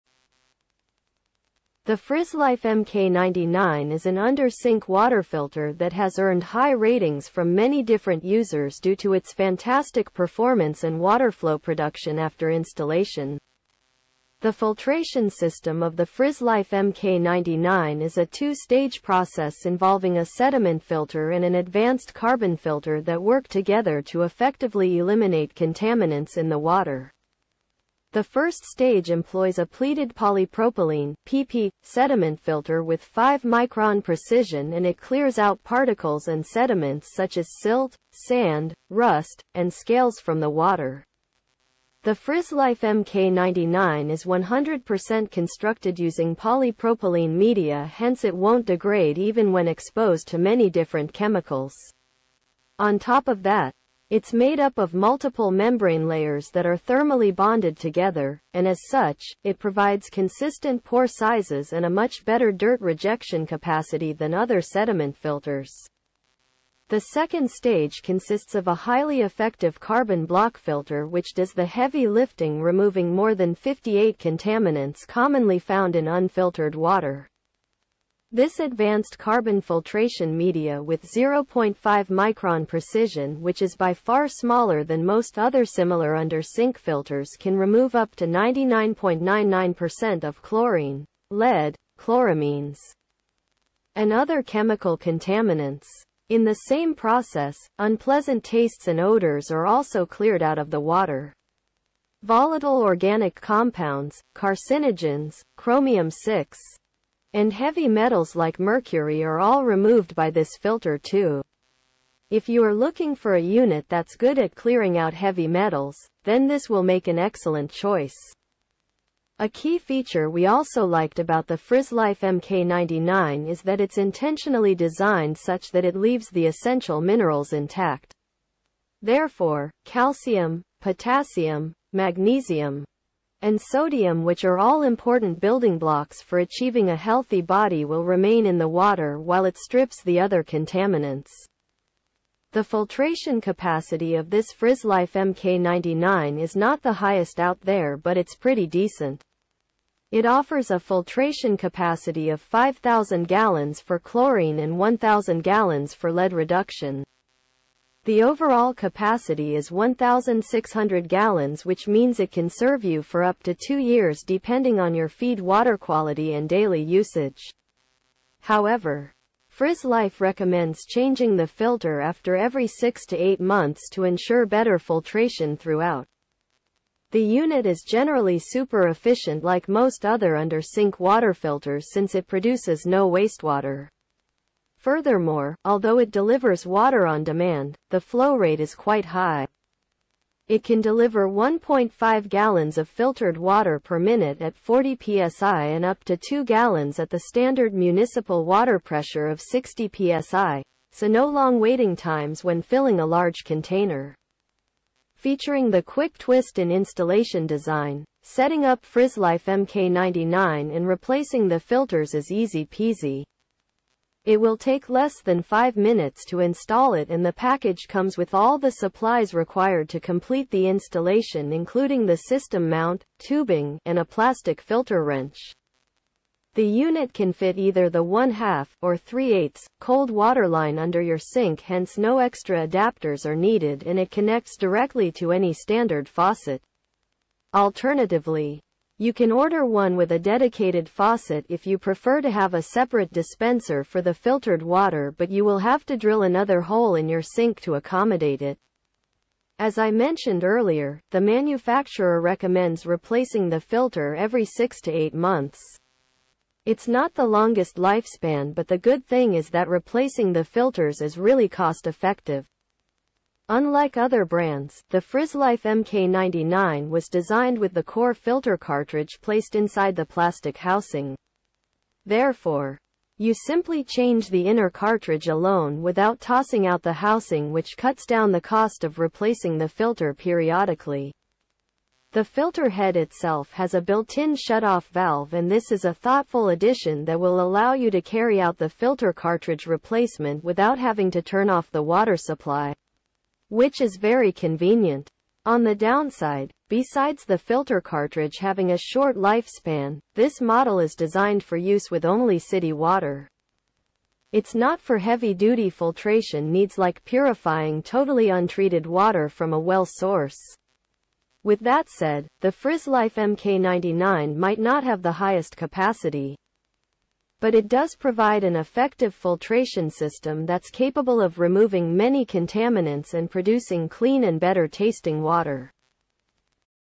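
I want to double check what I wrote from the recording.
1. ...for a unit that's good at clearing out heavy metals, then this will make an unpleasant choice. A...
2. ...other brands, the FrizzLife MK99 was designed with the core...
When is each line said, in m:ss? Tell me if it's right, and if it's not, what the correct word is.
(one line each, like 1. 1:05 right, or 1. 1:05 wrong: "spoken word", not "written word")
1. 1:53 wrong: "excellent", not "unpleasant"
2. 4:23 right.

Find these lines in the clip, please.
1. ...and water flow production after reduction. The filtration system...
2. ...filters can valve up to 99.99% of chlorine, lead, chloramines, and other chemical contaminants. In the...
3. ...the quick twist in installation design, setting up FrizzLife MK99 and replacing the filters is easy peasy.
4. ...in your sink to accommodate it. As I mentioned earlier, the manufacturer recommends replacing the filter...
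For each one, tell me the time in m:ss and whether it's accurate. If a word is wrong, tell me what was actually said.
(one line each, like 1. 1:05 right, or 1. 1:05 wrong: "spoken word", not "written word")
1. 0:10 wrong: "installation", not "reduction"
2. 1:26 wrong: "remove", not "valve"
3. 3:25 right
4. 4:06 right.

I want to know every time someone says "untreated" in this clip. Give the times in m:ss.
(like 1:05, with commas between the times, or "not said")
5:08.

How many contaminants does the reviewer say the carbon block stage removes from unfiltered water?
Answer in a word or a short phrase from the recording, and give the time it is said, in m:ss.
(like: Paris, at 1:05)
more than 58, at 1:13.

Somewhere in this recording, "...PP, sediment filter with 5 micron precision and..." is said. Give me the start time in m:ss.
0:31.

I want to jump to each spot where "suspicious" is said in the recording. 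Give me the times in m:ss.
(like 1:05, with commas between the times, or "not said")
not said.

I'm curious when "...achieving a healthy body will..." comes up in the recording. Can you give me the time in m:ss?
2:16.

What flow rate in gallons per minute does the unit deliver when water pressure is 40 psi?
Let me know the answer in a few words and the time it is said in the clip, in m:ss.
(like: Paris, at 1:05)
1.5 gallons, at 3:11.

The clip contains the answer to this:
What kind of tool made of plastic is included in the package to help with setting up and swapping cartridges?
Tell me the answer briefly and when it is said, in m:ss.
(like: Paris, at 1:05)
filter wrench, at 3:44.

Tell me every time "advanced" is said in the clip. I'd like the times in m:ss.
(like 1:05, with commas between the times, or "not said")
0:21, 1:18.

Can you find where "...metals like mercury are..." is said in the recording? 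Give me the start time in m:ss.
1:47.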